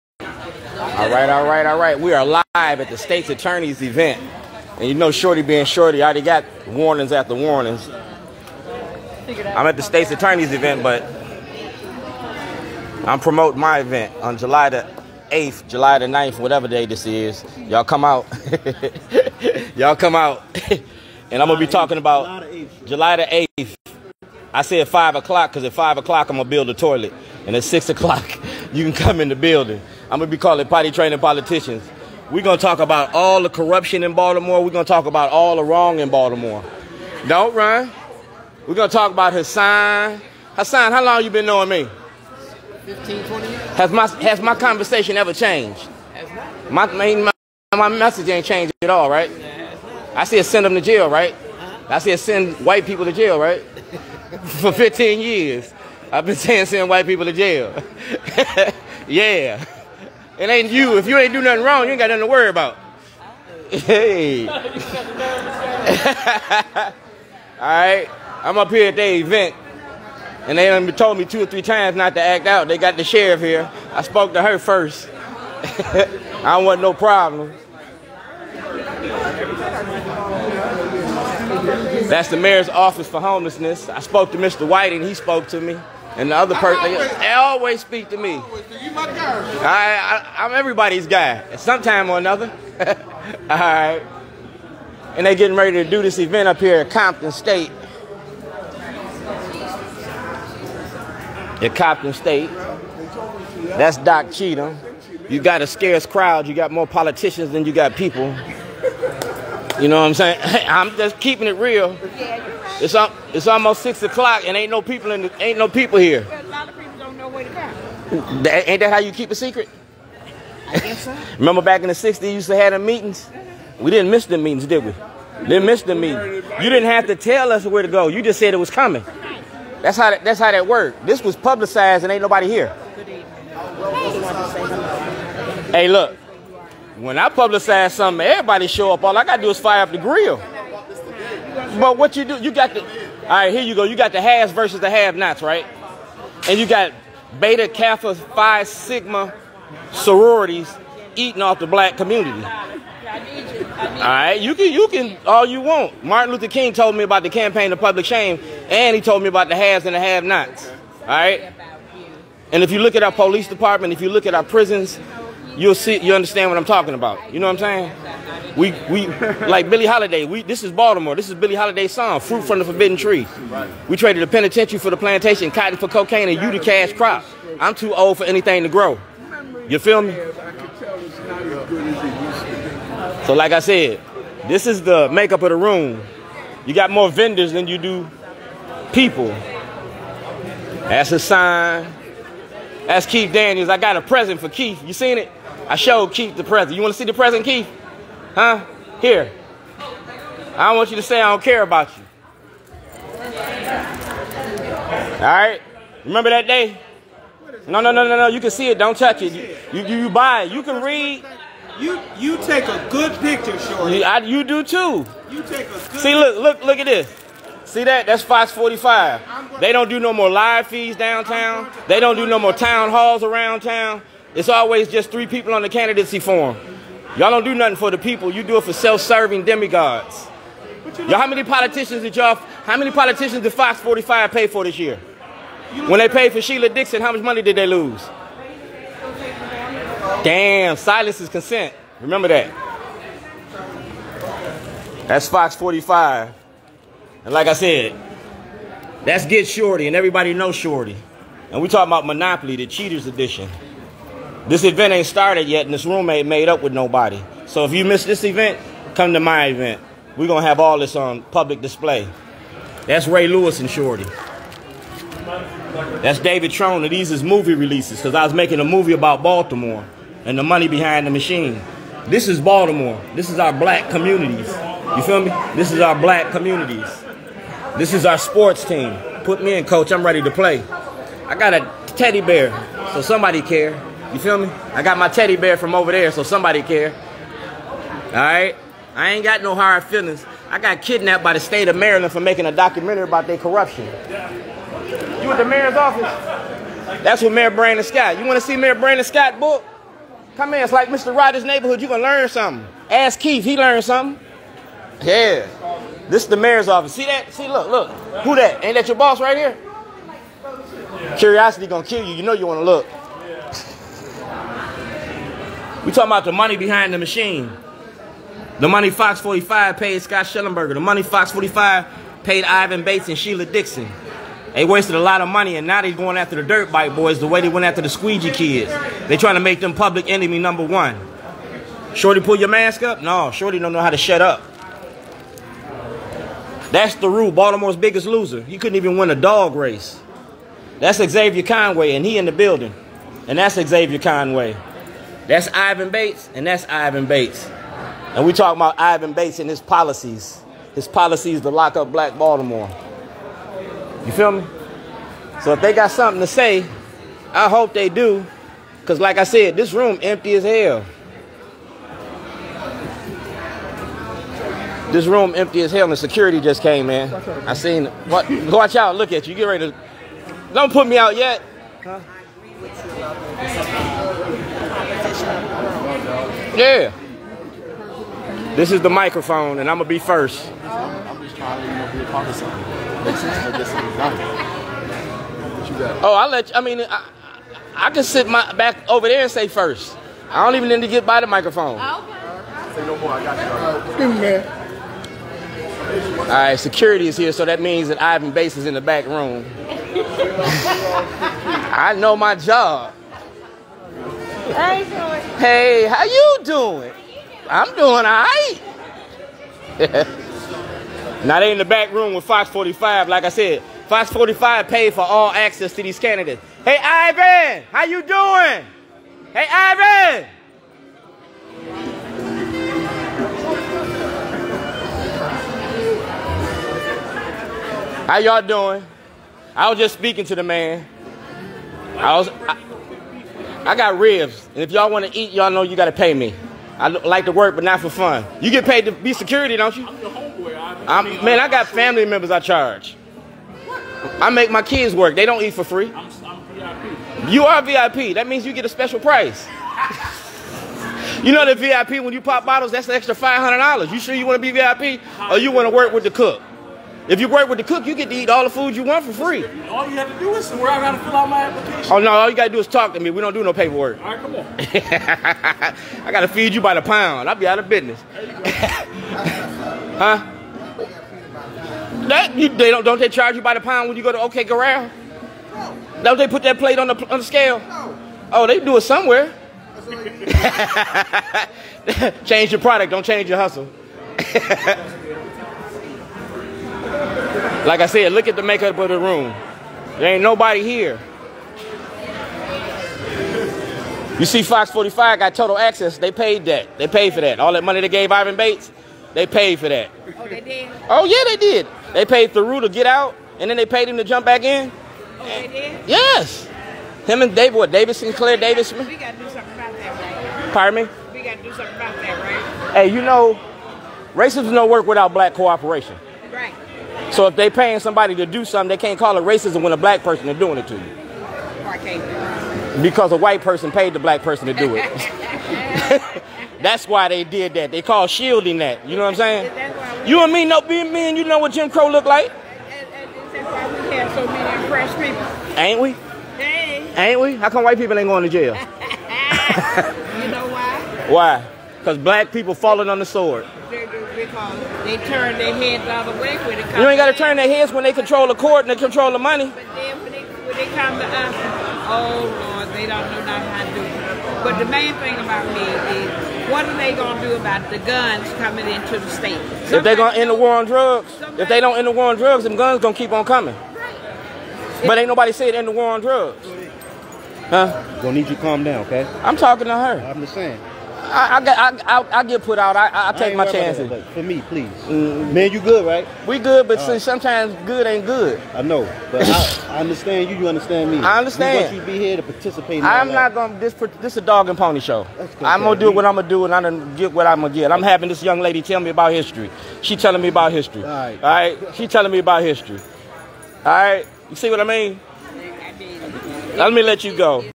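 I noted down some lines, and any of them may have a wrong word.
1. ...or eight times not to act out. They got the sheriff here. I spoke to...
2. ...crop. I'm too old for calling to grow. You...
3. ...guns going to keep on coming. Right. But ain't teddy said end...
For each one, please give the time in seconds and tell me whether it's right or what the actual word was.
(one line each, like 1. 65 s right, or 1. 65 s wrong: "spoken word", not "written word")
1. 71 s wrong: "three", not "eight"
2. 176 s wrong: "anything", not "calling"
3. 562 s wrong: "nobody", not "teddy".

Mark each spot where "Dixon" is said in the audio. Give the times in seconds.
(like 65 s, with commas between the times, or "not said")
236 s, 323 s.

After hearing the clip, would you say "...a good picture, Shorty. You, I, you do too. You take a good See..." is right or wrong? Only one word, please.
right.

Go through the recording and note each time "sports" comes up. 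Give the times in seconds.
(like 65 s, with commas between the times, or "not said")
278 s.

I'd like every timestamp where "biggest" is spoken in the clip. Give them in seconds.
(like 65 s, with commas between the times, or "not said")
337 s.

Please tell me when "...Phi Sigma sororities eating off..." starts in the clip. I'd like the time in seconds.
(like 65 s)
148 s.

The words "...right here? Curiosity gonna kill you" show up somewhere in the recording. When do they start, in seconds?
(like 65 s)
309 s.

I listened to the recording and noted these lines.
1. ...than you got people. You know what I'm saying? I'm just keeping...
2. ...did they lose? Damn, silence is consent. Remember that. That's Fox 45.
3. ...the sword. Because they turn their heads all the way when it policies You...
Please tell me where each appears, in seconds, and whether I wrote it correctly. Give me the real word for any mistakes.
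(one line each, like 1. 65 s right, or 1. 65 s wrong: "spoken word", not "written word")
1. 107 s right
2. 237 s right
3. 542 s wrong: "comes", not "policies".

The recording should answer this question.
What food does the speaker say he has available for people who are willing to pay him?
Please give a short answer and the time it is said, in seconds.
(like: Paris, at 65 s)
Ribs, at 433 s.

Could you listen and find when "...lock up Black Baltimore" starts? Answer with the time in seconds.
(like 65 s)
351 s.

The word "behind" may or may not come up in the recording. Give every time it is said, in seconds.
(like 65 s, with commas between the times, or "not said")
270 s, 316 s.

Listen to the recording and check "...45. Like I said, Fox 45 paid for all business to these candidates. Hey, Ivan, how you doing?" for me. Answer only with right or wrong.
wrong.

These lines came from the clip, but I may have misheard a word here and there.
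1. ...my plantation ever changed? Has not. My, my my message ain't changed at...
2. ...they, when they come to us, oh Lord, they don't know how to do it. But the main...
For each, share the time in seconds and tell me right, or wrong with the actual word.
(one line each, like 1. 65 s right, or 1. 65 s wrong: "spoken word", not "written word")
1. 44 s wrong: "conversation", not "plantation"
2. 550 s right.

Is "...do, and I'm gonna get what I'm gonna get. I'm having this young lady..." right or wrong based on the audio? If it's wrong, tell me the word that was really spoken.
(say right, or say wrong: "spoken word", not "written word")
right.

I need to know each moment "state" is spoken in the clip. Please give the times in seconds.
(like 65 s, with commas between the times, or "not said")
2 s, 9 s, 97 s, 102 s, 291 s, 559 s.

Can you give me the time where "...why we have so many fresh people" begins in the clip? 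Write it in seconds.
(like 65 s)
533 s.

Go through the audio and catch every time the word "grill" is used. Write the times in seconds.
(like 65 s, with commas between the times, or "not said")
139 s.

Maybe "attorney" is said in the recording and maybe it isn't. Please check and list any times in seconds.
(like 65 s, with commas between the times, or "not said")
3 s, 10 s.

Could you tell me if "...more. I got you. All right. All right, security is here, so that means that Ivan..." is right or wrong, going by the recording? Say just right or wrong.
right.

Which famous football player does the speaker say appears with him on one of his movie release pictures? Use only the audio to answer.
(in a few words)
Ray Lewis.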